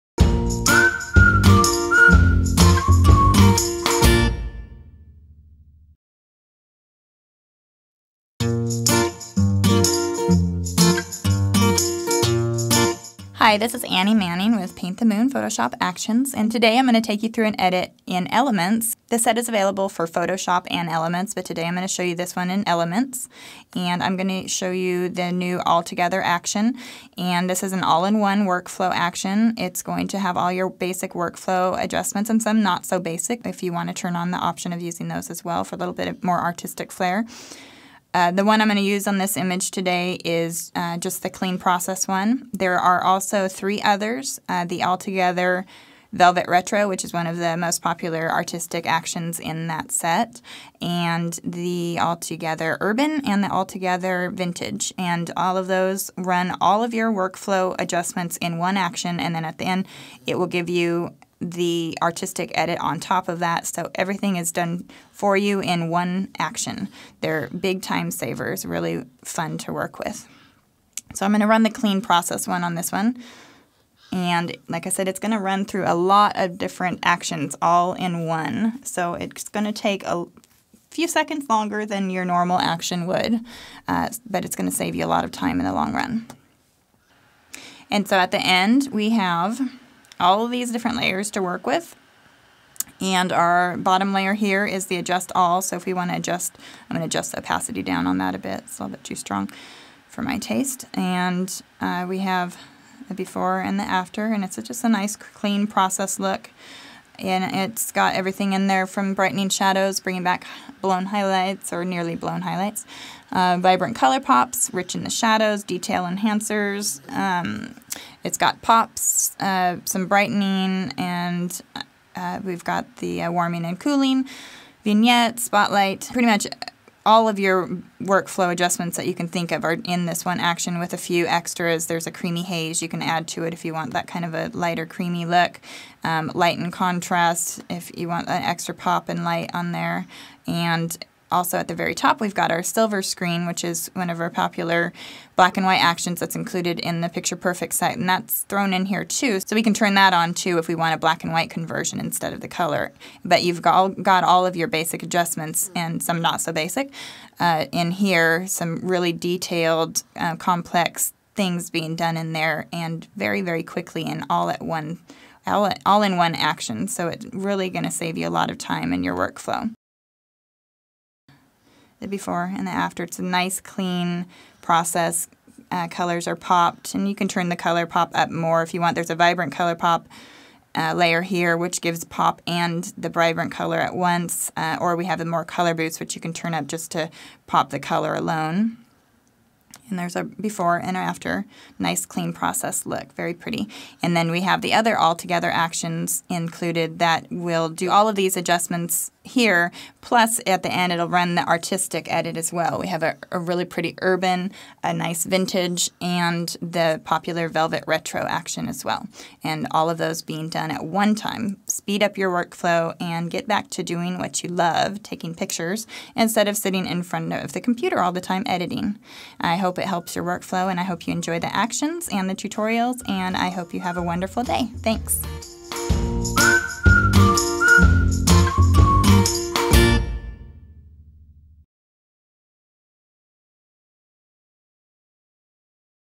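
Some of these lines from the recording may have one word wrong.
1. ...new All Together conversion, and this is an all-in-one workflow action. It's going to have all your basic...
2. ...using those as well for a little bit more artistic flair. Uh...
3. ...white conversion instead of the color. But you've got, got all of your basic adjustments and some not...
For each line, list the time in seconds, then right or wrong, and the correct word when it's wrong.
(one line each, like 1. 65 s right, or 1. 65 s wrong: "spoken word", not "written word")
1. 25 s wrong: "action", not "conversion"
2. 34 s right
3. 151 s right.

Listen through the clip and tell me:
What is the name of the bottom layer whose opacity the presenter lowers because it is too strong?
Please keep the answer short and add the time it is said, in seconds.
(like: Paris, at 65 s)
adjust all, at 94 s.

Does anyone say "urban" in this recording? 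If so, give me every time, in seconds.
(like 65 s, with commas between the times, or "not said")
52 s, 204 s.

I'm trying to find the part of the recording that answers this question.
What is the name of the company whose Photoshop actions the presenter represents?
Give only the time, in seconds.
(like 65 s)
14 s.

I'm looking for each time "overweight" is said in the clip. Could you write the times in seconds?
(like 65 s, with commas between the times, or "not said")
not said.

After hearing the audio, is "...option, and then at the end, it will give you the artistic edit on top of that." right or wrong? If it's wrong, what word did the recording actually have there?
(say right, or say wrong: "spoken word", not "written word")
wrong: "action", not "option".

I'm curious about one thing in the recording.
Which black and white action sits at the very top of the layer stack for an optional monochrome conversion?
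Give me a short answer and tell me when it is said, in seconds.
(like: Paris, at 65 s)
silver screen, at 142 s.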